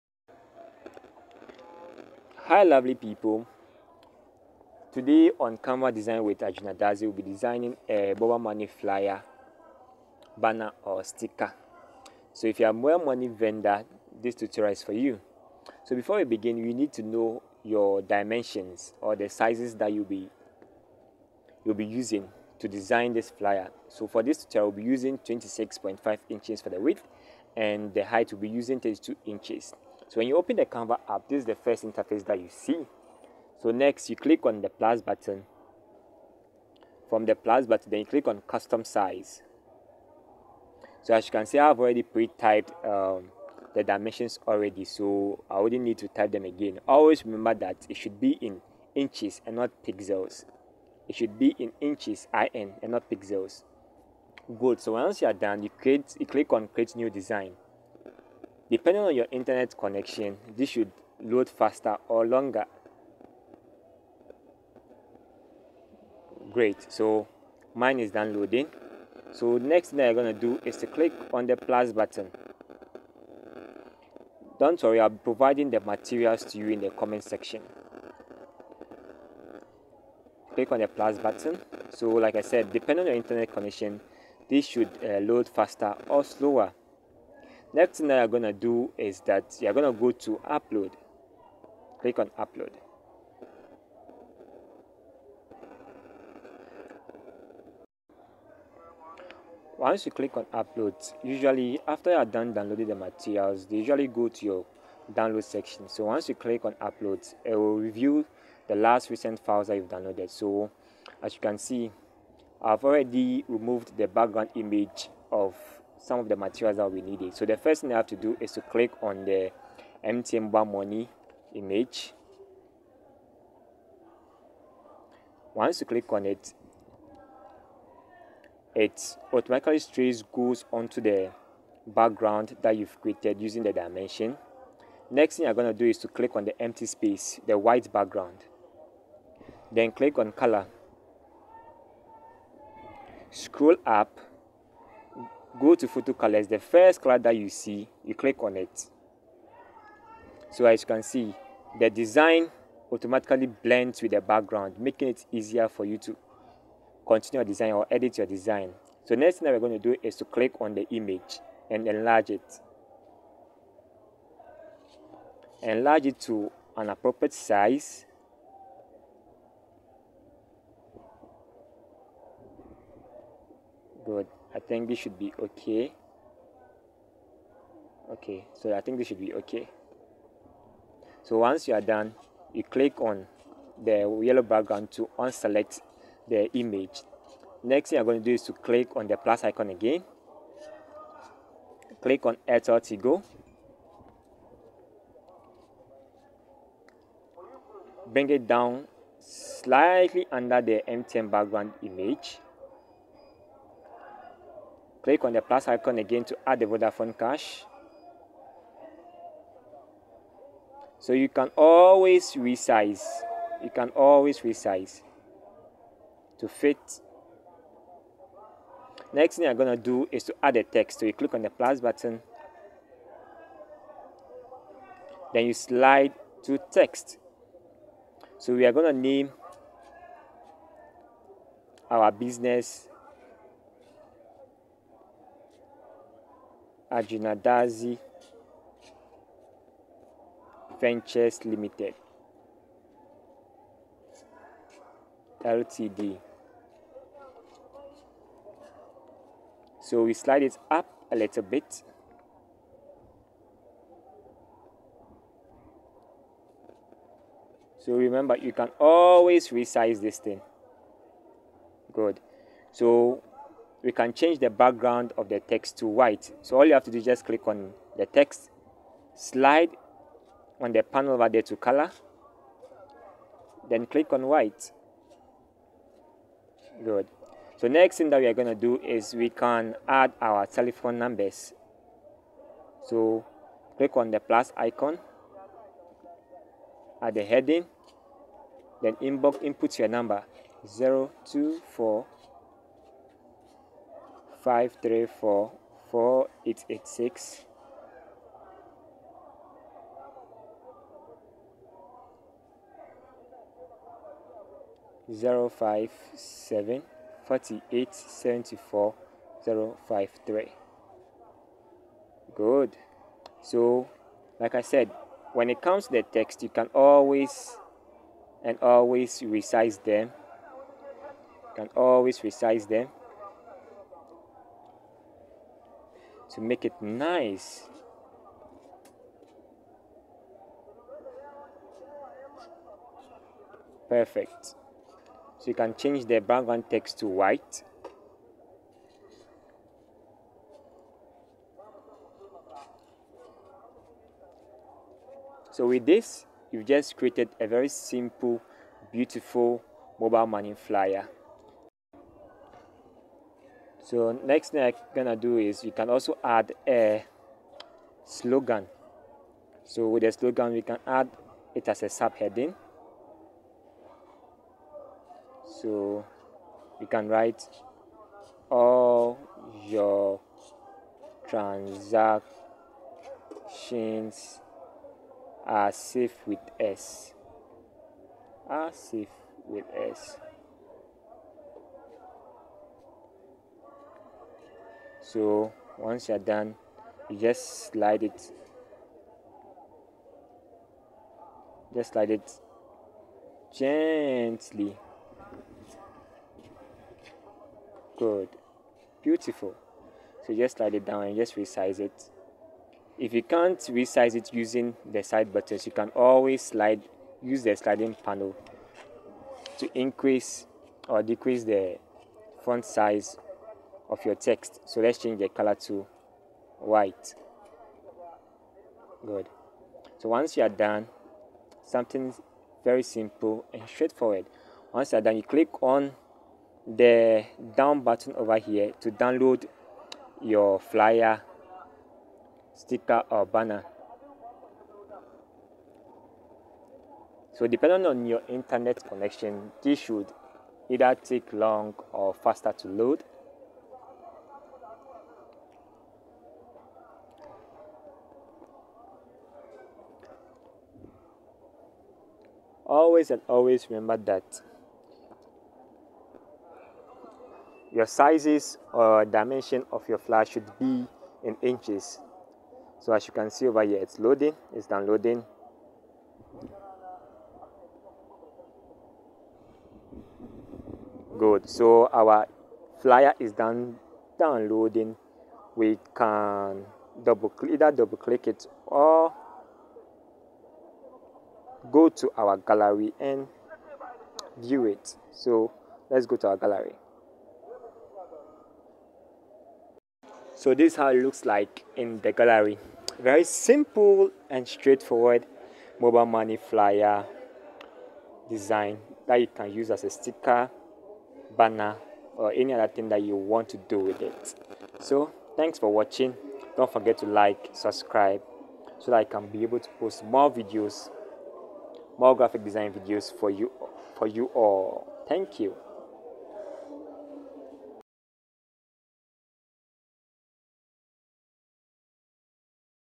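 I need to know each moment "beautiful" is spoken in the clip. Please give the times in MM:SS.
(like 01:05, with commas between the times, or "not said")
05:48, 06:39.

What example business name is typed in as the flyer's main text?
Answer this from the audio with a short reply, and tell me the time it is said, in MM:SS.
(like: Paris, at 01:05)
Arjuna Dadzie Ventures Limited, at 03:56.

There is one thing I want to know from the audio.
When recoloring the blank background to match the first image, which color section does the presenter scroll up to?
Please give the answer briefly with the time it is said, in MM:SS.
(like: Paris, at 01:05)
photo colors, at 02:25.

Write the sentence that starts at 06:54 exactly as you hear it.
So let's change the color to white.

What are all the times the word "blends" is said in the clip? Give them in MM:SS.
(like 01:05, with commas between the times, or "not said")
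02:33.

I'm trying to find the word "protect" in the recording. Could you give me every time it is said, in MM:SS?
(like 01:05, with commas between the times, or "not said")
not said.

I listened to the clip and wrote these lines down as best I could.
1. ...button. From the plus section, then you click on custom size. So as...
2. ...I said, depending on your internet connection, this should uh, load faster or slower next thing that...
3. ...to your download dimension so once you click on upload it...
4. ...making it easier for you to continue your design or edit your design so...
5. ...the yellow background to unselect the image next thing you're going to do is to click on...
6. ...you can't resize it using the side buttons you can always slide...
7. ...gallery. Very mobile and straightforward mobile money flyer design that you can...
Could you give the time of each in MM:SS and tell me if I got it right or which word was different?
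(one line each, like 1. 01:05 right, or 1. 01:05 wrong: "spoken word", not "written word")
1. 00:35 wrong: "button", not "section"
2. 01:22 right
3. 01:44 wrong: "section", not "dimension"
4. 02:34 right
5. 03:03 right
6. 06:43 right
7. 08:12 wrong: "simple", not "mobile".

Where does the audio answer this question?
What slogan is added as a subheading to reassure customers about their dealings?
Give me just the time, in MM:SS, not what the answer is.
06:08.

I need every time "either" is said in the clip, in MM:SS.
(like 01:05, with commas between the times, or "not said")
07:20, 07:57.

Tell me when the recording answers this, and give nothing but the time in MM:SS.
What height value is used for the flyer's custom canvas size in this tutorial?
00:28.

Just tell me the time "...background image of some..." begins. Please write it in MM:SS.
01:54.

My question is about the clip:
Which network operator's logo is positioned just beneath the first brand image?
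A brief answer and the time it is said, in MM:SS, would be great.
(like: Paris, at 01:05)
Airtel Tigo, at 03:12.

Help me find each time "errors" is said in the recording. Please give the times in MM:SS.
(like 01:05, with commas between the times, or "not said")
not said.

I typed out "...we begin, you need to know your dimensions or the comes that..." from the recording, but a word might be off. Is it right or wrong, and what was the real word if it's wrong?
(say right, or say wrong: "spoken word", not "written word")
wrong: "sizes", not "comes".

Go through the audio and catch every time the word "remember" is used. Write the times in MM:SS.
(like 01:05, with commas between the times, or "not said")
00:47, 04:17, 07:33.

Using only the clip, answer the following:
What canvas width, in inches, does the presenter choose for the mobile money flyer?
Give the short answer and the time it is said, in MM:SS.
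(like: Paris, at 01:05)
26.5 inches, at 00:25.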